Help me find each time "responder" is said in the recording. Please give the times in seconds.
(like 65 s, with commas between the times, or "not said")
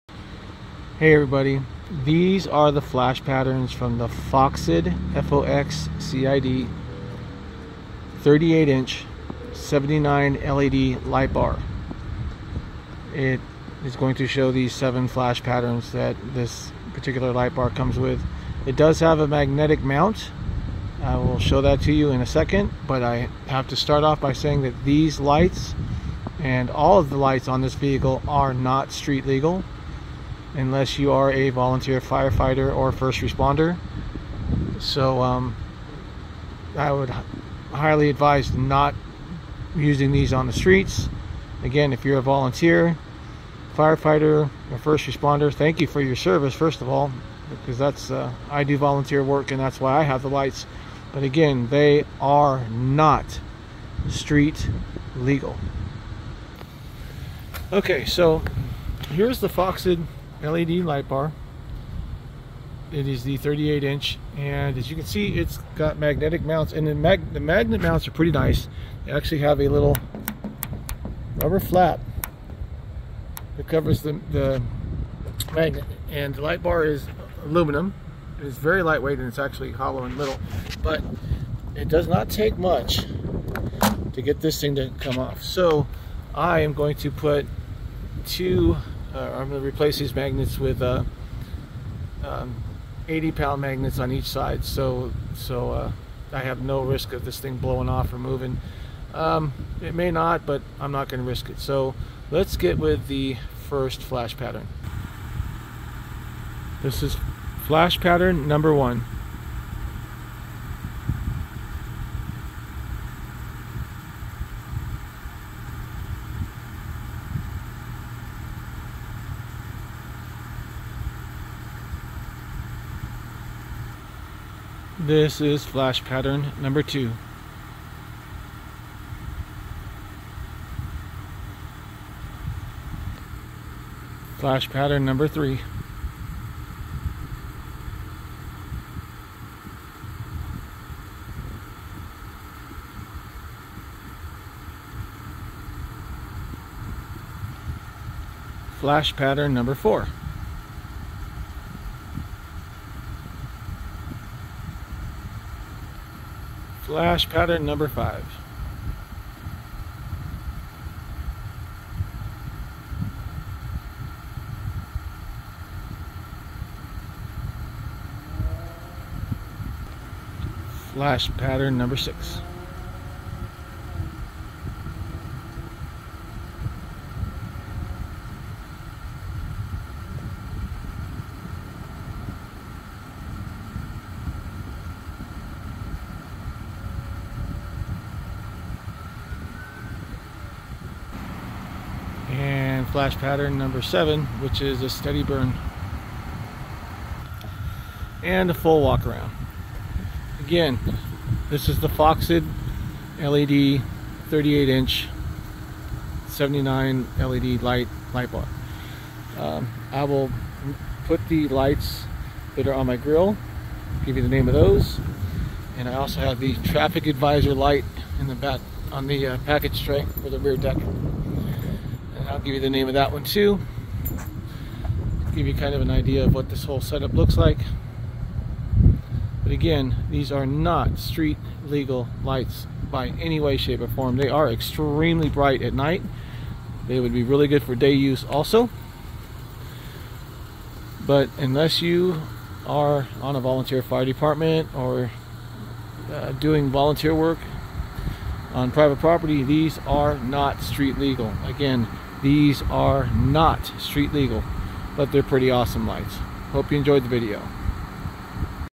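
33 s, 45 s.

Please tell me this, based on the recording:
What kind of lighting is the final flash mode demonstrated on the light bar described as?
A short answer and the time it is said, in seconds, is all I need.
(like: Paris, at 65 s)
Steady burn, at 194 s.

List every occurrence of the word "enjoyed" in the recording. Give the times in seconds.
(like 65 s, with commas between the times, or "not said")
256 s.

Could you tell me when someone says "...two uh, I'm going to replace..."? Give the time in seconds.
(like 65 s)
88 s.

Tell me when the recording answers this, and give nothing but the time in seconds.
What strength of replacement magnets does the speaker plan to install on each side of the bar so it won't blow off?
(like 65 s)
93 s.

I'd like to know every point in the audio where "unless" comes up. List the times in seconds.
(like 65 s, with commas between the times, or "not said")
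30 s, 241 s.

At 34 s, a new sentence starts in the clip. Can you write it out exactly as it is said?
So um, I would highly advise not using these on the streets.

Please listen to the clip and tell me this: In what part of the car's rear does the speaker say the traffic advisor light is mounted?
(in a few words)
Package tray.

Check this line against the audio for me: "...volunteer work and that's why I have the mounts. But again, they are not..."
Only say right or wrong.
wrong.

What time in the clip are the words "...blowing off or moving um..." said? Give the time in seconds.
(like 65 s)
97 s.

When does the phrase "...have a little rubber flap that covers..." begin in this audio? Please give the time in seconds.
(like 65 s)
69 s.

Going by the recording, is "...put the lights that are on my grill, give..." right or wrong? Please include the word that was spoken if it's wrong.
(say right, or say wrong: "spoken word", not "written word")
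right.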